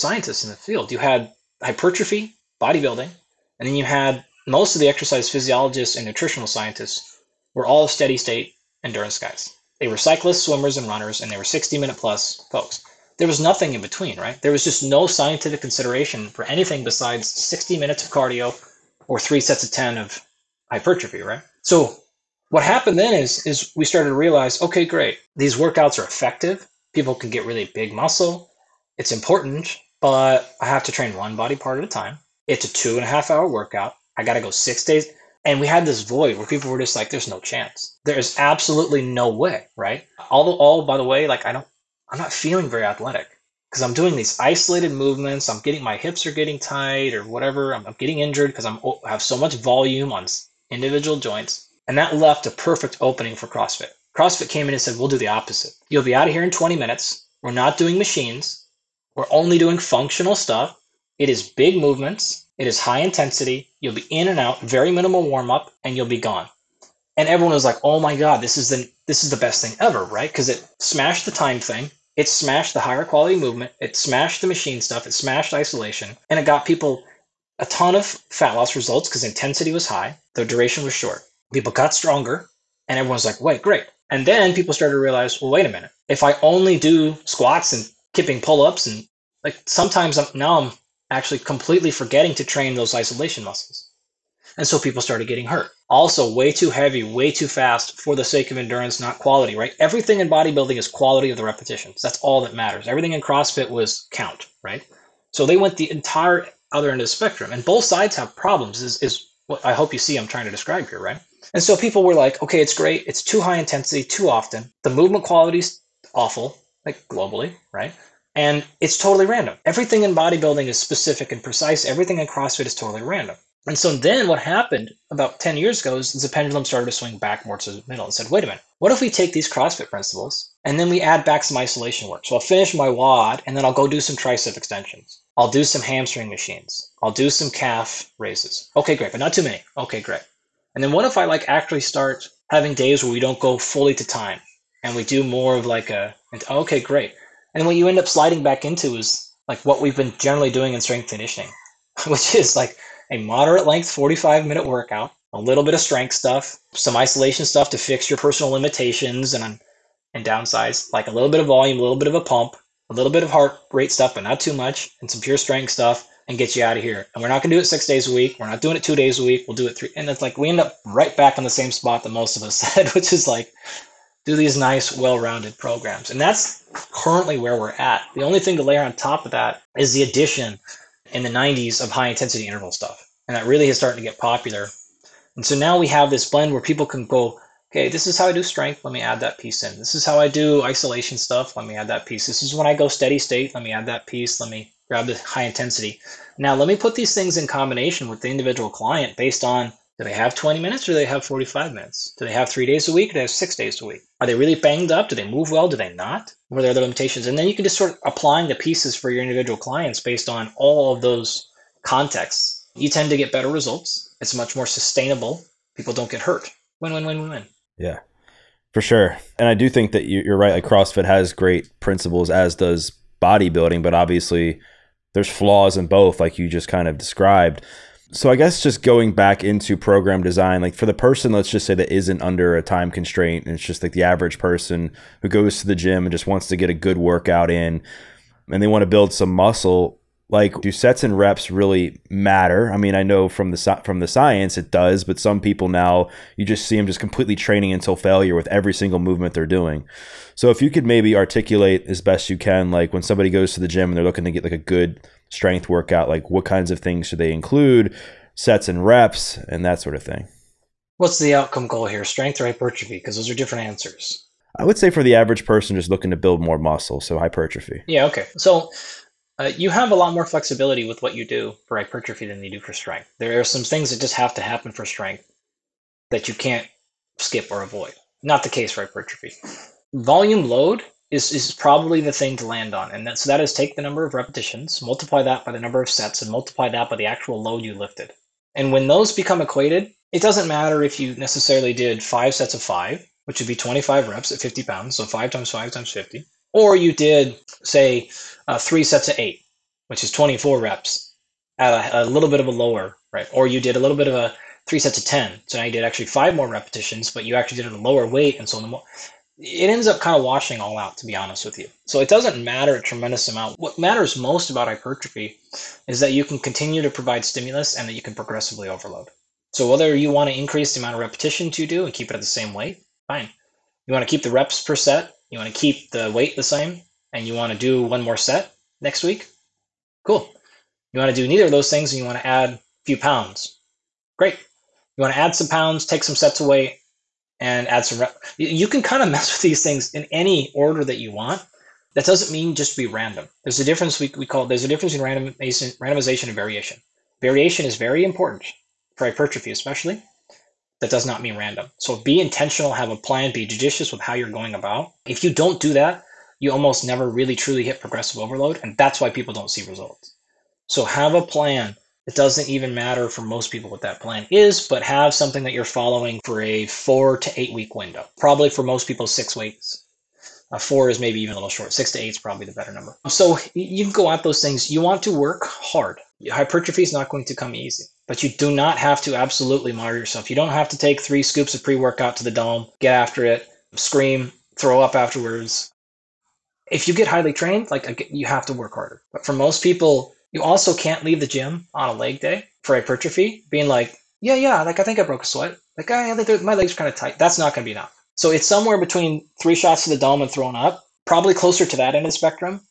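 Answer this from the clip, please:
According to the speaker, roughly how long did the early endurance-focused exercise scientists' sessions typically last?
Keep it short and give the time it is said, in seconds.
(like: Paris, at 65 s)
60 minutes plus, at 11 s.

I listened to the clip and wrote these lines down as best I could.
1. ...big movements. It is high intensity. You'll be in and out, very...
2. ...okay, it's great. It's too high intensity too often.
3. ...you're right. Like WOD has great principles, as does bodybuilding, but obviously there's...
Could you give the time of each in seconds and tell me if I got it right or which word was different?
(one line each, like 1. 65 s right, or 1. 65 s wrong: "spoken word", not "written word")
1. 61 s right
2. 112 s right
3. 220 s wrong: "CrossFit", not "WOD".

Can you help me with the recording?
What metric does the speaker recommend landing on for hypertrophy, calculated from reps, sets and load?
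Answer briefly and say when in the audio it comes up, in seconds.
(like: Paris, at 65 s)
Volume load, at 279 s.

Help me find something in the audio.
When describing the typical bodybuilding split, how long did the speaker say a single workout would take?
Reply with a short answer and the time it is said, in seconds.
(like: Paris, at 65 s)
2.5 hours, at 32 s.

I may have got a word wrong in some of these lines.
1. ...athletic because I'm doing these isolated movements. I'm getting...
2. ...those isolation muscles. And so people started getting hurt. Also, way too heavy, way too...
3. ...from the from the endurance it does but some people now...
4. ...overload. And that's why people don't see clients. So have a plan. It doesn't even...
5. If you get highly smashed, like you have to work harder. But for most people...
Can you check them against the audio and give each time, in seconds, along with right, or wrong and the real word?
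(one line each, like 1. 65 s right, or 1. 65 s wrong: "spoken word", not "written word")
1. 42 s right
2. 92 s right
3. 243 s wrong: "science", not "endurance"
4. 358 s wrong: "results", not "clients"
5. 386 s wrong: "trained", not "smashed".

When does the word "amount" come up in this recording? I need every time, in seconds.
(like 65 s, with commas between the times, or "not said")
313 s, 320 s.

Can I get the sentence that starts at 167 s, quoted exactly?
And we're not going to do it six days a week.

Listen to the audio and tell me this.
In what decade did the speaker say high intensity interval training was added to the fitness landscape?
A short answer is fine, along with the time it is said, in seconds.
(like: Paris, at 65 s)
the 90s, at 181 s.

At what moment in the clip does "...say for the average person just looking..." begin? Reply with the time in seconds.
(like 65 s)
264 s.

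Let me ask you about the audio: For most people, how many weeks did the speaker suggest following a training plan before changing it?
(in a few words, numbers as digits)
6 weeks.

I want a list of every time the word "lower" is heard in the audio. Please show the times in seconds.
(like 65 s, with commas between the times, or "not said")
302 s, 307 s.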